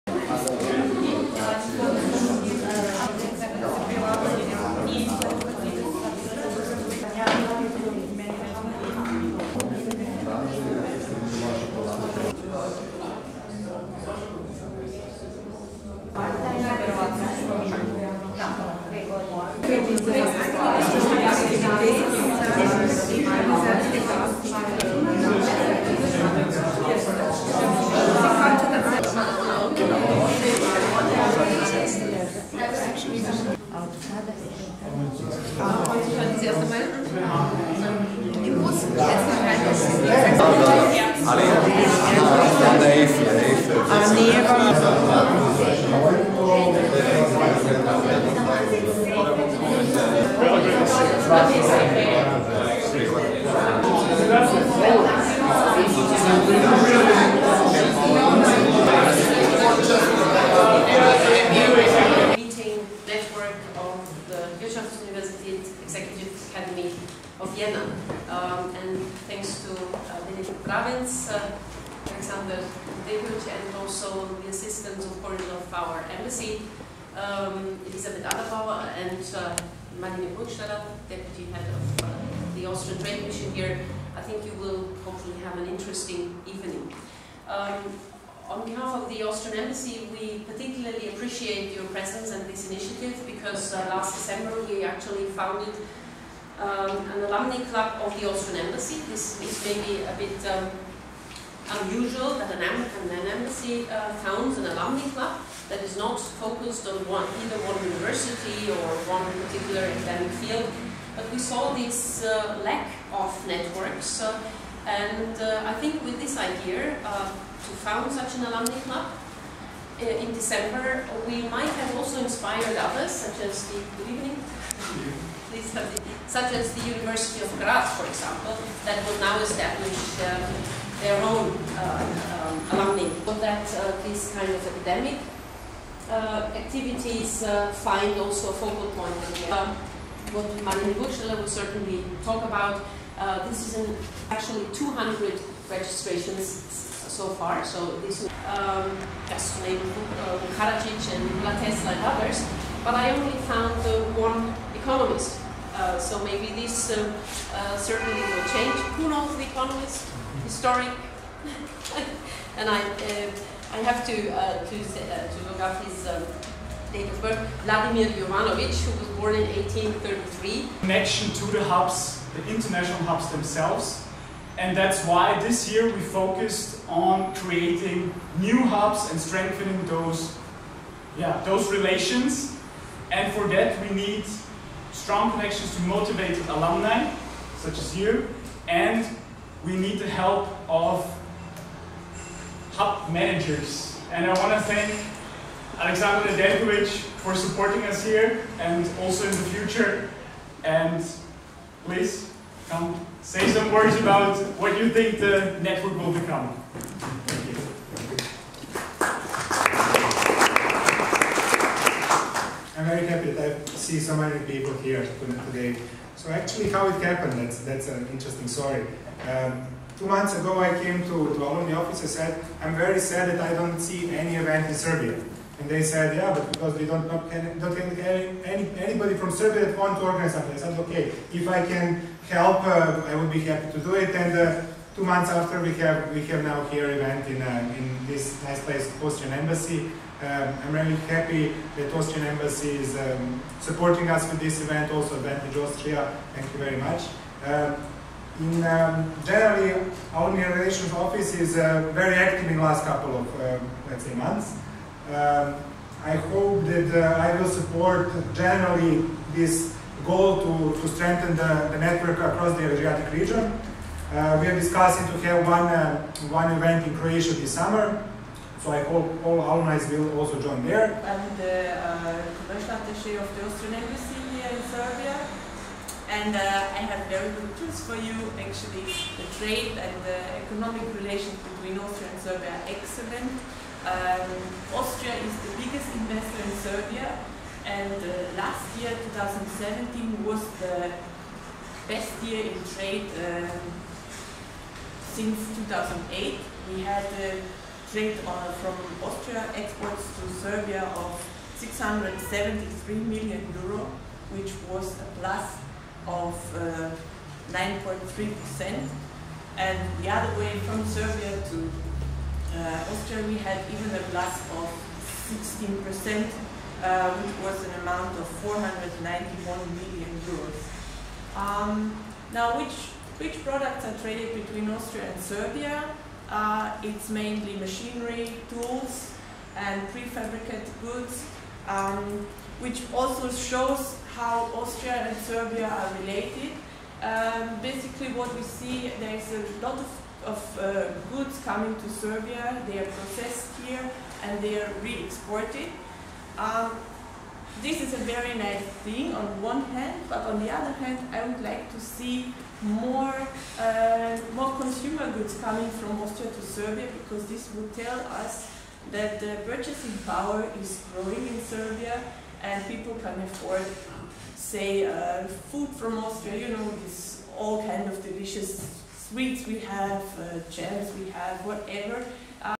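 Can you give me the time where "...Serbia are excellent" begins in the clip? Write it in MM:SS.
04:42.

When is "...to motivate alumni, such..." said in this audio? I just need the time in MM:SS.
03:05.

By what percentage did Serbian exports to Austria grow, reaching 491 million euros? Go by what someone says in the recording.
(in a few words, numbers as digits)
16%.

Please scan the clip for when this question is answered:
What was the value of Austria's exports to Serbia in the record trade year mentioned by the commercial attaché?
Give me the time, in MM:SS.
05:01.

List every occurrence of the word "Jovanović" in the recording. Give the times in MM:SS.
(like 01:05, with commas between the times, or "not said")
02:48.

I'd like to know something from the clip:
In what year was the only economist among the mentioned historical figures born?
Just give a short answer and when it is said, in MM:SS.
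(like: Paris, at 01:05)
1833, at 02:49.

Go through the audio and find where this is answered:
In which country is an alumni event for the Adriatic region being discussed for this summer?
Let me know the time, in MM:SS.
04:26.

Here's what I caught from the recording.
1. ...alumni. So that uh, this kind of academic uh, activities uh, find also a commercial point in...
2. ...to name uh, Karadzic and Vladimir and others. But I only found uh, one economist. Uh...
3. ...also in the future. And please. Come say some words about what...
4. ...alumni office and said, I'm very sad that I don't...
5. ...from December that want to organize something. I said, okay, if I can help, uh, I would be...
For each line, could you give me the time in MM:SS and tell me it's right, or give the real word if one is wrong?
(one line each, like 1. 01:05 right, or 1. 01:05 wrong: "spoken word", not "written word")
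1. 02:12 wrong: "focal", not "commercial"
2. 02:29 wrong: "Nikola", not "Vladimir"
3. 03:19 right
4. 03:41 right
5. 03:49 wrong: "Serbia", not "December".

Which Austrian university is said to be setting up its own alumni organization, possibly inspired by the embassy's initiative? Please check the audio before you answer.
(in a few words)
University of Graz.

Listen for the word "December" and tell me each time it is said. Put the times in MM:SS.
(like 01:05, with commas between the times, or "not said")
01:34, 02:00.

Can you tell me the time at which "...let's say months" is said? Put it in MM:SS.
04:13.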